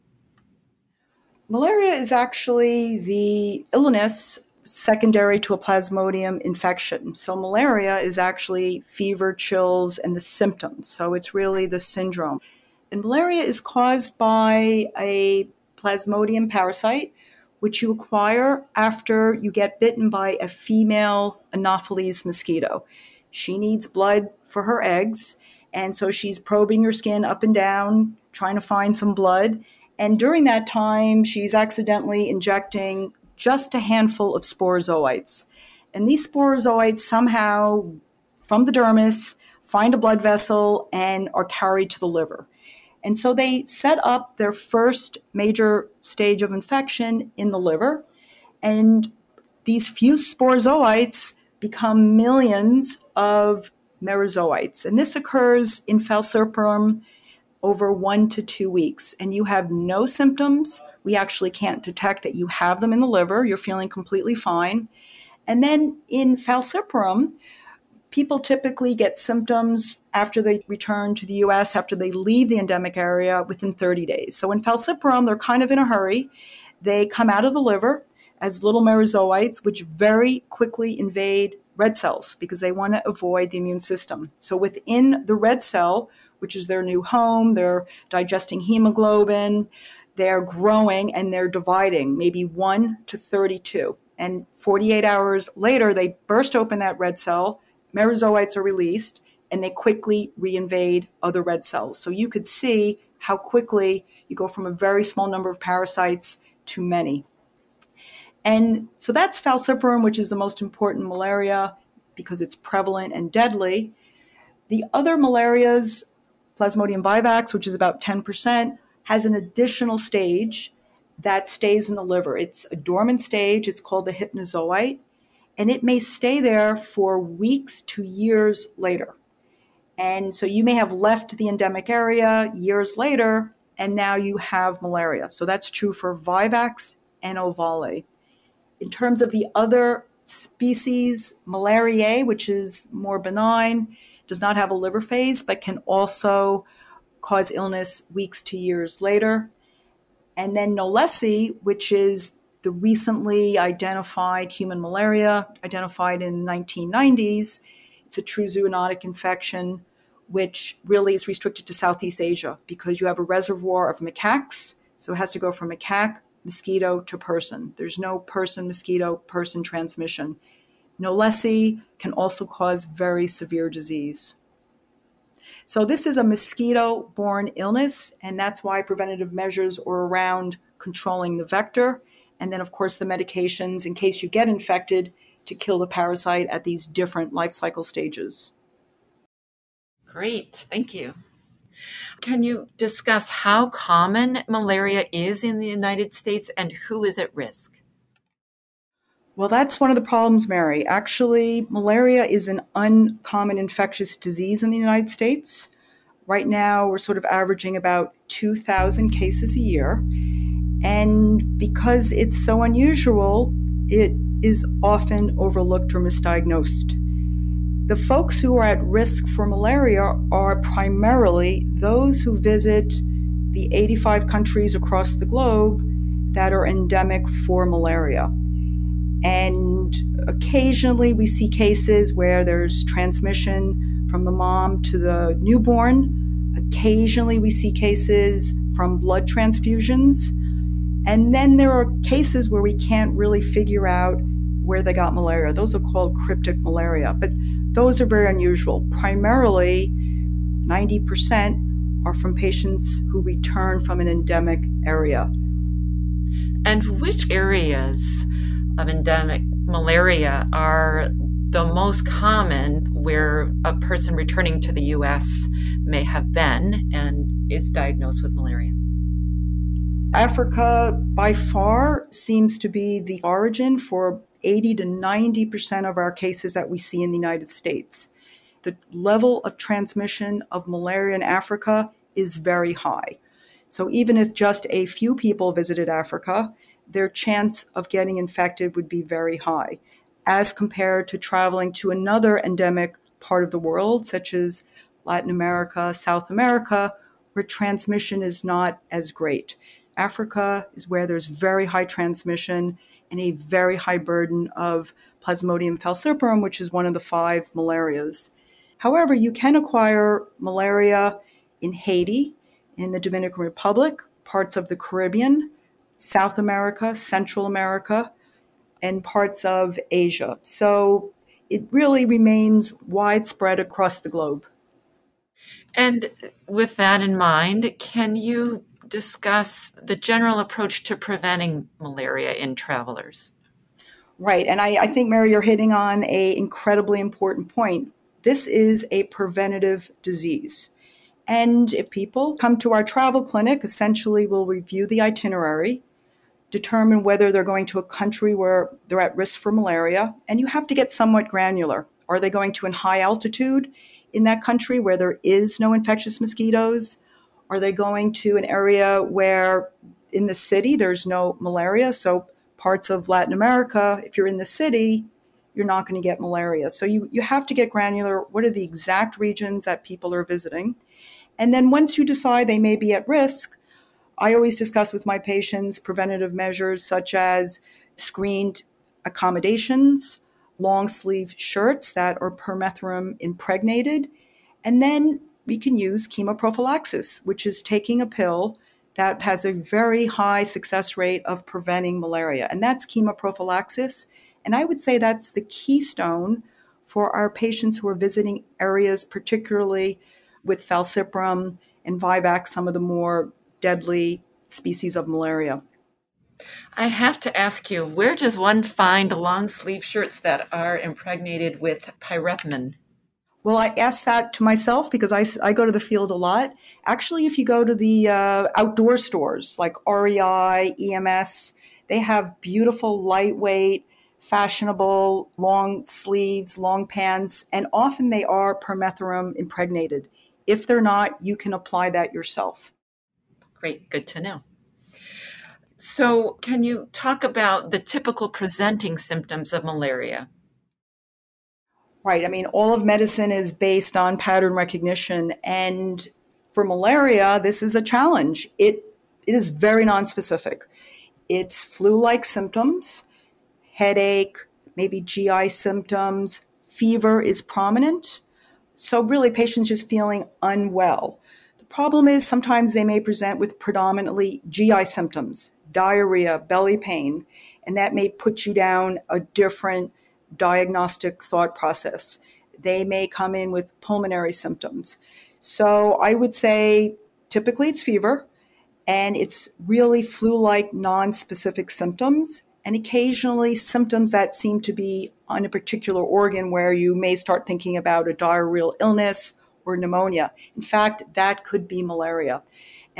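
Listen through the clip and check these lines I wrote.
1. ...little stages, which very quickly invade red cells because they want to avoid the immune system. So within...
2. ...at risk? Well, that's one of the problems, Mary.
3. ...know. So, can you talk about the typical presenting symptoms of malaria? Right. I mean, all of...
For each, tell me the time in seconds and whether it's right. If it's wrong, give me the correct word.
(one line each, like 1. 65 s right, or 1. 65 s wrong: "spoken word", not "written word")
1. 78 s wrong: "merozoites", not "stages"
2. 197 s right
3. 434 s right.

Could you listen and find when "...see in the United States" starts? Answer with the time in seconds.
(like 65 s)
276 s.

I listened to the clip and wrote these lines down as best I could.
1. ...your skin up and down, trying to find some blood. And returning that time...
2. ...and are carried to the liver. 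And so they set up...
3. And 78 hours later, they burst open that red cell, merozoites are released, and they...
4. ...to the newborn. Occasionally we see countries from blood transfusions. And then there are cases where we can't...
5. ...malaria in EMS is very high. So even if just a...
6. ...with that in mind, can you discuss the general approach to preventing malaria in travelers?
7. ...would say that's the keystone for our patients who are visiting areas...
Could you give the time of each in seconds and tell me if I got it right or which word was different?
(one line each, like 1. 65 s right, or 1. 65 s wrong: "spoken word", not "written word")
1. 26 s wrong: "during", not "returning"
2. 40 s right
3. 94 s wrong: "48", not "78"
4. 234 s wrong: "cases", not "countries"
5. 280 s wrong: "Africa", not "EMS"
6. 326 s right
7. 394 s right.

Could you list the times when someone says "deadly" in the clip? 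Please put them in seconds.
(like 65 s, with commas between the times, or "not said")
113 s, 403 s.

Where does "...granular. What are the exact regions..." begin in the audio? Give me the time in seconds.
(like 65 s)
367 s.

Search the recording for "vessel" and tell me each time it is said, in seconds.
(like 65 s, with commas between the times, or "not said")
40 s.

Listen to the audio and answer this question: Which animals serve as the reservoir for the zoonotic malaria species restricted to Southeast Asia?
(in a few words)
macaques.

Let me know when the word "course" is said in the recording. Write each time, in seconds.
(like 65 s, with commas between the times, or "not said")
182 s.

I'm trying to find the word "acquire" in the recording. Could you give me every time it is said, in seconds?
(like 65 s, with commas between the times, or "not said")
17 s, 309 s.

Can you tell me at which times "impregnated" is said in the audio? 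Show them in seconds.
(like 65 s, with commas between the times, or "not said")
383 s, 410 s, 429 s.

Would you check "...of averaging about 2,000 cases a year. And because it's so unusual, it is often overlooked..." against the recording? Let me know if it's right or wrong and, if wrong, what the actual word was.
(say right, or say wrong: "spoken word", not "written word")
right.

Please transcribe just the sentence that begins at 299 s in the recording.
Africa is where there's very high transmission and a very high burden of Plasmodium falciparum, which is one of the five malarias.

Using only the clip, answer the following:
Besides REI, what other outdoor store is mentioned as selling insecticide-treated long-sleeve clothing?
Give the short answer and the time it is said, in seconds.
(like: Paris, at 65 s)
EMS, at 420 s.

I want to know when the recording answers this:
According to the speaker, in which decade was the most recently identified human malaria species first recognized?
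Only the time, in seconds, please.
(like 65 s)
156 s.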